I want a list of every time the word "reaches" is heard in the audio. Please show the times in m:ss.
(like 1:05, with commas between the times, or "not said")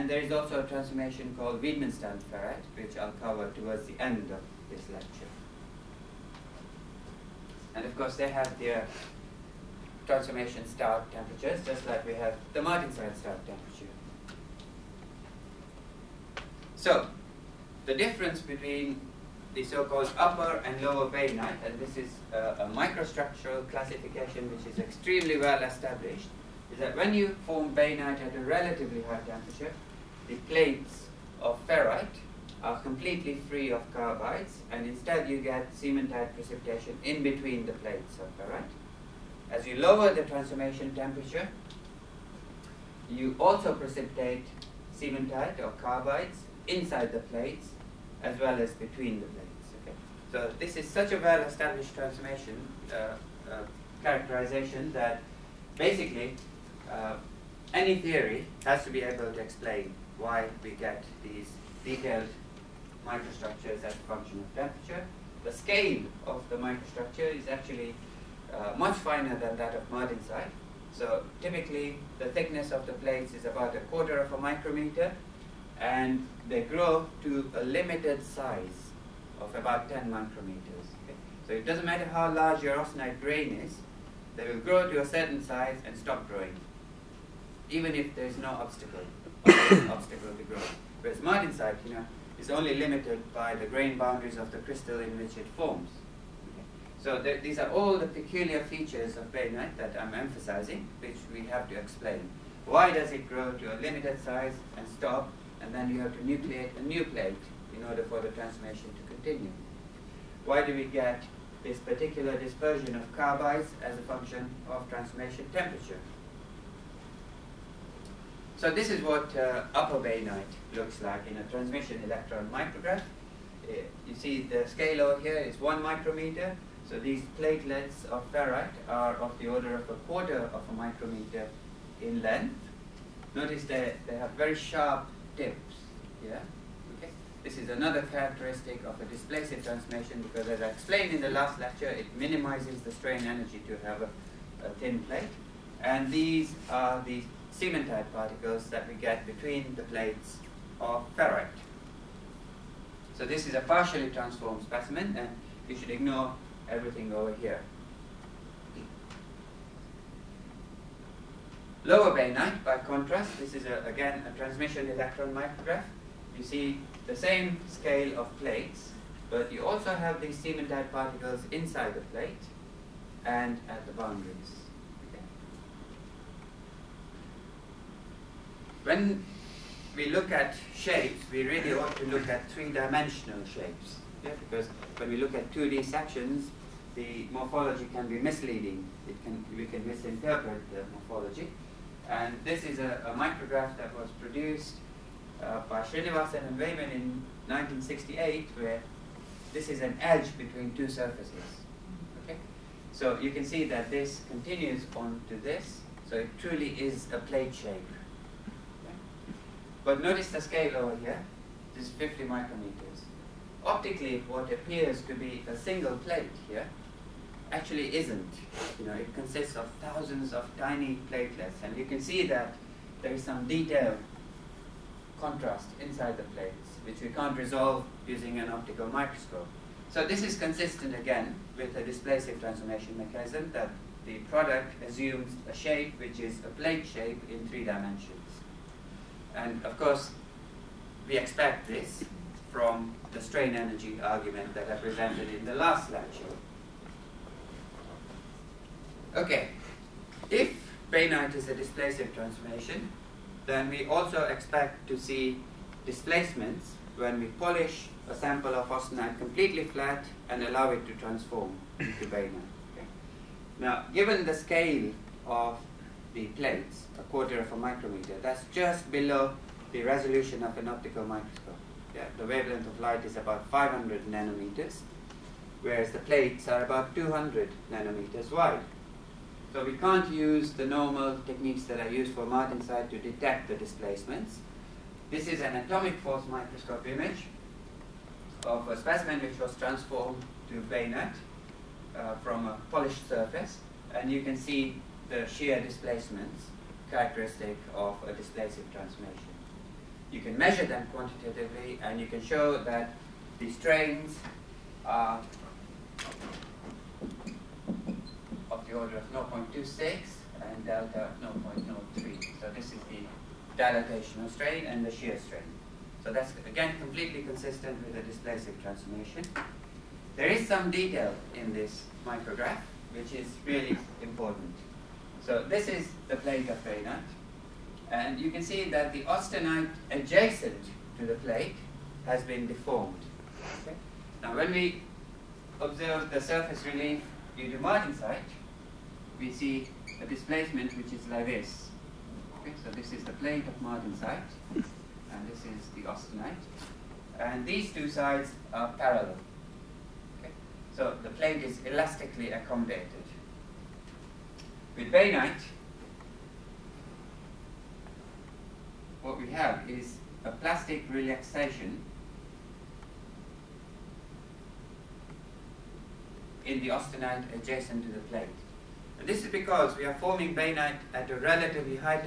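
not said.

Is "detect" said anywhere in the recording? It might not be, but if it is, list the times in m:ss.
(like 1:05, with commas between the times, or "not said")
4:42.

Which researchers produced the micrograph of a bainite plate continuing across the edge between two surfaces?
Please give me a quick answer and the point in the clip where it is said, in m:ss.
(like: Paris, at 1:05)
Srinivasan and Wayman, at 3:15.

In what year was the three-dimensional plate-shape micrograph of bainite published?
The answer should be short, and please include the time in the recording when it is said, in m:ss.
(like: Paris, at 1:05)
1968, at 3:17.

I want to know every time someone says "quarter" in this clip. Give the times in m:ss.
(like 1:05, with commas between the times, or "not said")
1:13, 2:10, 4:27.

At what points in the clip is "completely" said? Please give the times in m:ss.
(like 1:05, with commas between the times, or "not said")
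0:32, 4:19, 5:16.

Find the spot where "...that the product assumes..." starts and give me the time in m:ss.
3:53.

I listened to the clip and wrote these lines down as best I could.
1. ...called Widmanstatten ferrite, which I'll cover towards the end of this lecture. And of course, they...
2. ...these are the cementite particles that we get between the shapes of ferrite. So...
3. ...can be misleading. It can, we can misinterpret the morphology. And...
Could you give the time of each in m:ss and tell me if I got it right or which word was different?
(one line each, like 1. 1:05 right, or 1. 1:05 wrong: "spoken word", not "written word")
1. 0:01 right
2. 2:26 wrong: "plates", not "shapes"
3. 3:07 right.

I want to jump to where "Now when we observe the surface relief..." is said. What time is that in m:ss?
5:34.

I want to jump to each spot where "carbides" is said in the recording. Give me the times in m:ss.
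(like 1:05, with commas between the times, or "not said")
0:33, 0:45, 1:53.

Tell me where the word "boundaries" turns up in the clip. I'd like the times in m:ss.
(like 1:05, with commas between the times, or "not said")
1:33, 2:53.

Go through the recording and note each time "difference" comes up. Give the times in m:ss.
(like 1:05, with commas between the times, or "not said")
0:17.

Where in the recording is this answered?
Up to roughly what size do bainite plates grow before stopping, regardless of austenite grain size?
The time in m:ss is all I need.
1:19.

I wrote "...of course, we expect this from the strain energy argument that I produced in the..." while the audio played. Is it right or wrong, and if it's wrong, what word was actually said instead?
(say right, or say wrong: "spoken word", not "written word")
wrong: "presented", not "produced".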